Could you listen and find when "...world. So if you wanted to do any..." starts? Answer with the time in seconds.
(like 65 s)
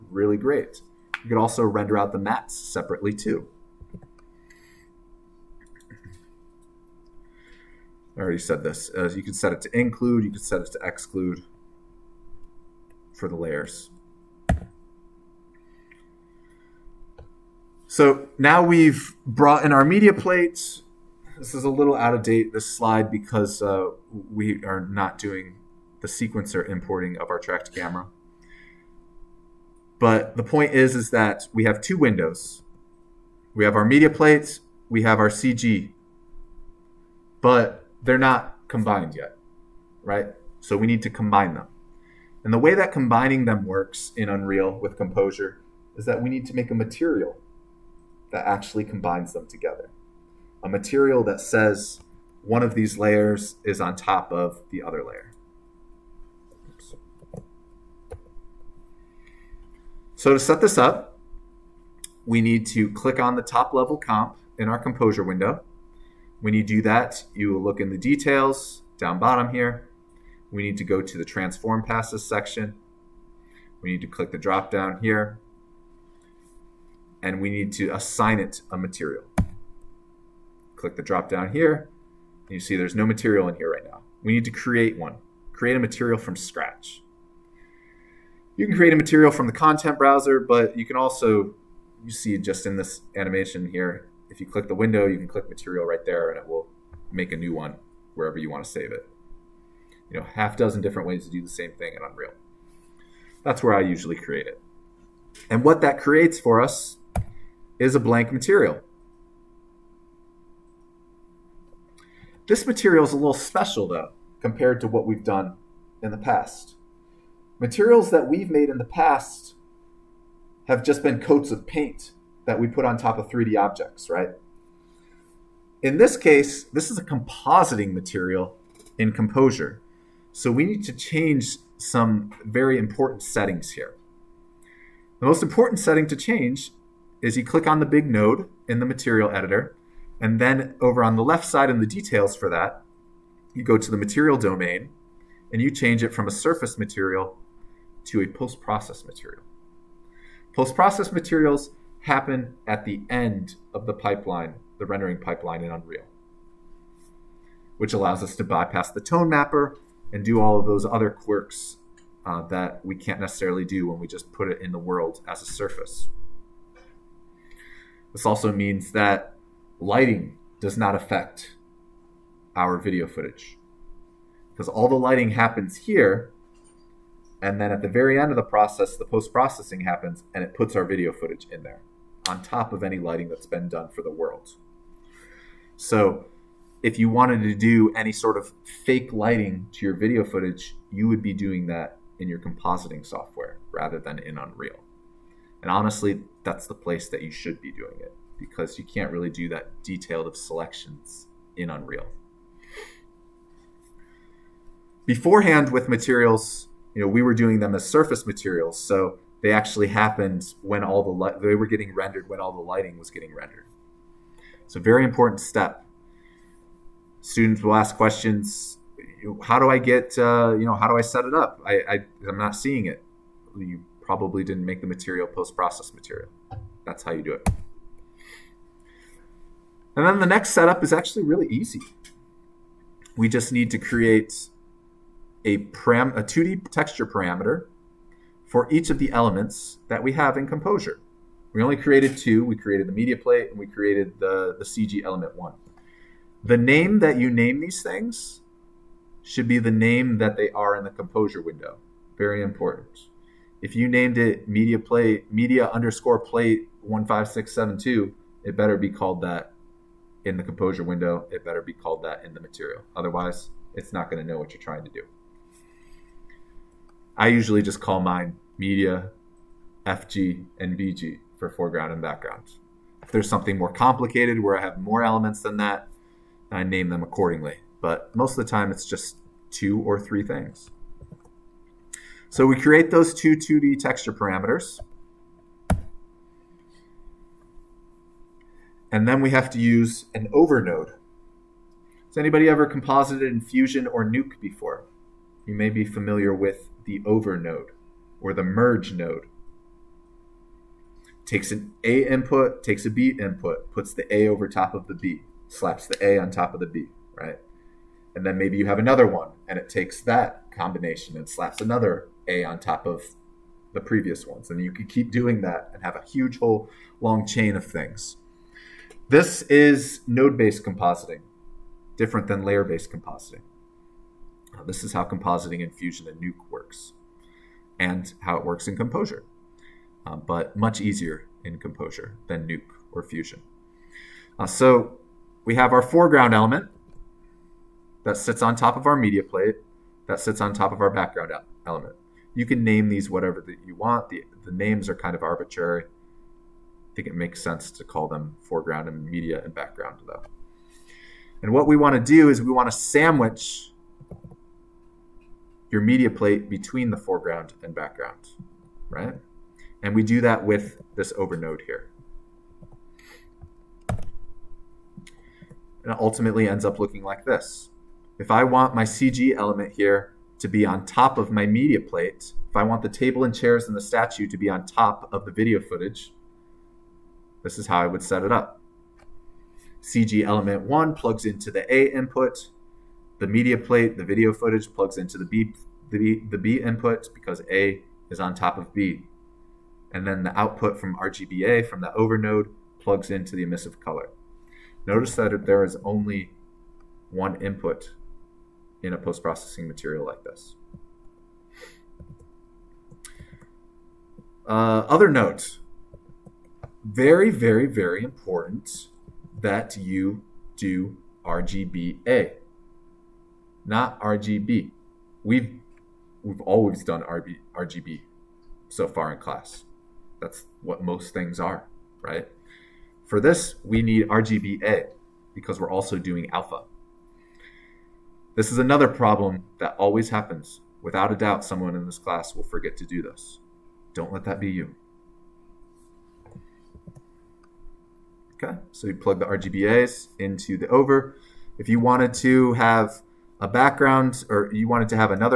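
184 s.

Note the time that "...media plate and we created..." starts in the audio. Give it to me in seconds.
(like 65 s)
242 s.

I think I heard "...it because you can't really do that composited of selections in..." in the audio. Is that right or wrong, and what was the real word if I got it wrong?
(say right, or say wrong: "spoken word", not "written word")
wrong: "detailed", not "composited".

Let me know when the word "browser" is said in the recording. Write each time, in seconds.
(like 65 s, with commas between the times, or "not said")
89 s.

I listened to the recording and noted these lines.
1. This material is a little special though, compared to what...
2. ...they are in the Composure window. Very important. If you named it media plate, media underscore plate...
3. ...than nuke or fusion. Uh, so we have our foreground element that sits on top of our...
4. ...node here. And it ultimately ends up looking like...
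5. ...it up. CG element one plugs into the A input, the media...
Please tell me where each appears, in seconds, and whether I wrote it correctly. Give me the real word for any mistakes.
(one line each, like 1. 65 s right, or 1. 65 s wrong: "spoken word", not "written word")
1. 112 s right
2. 250 s right
3. 332 s right
4. 361 s right
5. 378 s right.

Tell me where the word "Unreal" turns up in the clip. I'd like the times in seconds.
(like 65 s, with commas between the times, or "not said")
44 s, 102 s, 155 s, 194 s, 201 s.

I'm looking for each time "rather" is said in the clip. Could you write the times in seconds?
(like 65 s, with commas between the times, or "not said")
193 s.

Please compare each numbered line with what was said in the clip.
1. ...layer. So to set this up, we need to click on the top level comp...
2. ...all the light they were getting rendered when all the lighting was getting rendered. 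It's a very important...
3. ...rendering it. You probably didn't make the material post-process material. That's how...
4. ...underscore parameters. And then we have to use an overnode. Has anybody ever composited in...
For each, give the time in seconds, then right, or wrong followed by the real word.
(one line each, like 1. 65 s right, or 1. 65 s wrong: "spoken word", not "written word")
1. 55 s right
2. 210 s right
3. 222 s wrong: "seeing", not "rendering"
4. 283 s wrong: "texture", not "underscore".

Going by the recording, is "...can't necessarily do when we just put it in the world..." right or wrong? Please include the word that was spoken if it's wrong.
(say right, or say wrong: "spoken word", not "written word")
right.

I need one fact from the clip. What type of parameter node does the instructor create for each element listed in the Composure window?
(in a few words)
2D texture parameter.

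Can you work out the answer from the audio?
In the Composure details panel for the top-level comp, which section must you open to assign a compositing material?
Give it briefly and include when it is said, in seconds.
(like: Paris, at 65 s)
Transform passes, at 71 s.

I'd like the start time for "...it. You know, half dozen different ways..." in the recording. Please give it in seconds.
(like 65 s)
98 s.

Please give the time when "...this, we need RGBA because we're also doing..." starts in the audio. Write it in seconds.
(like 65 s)
423 s.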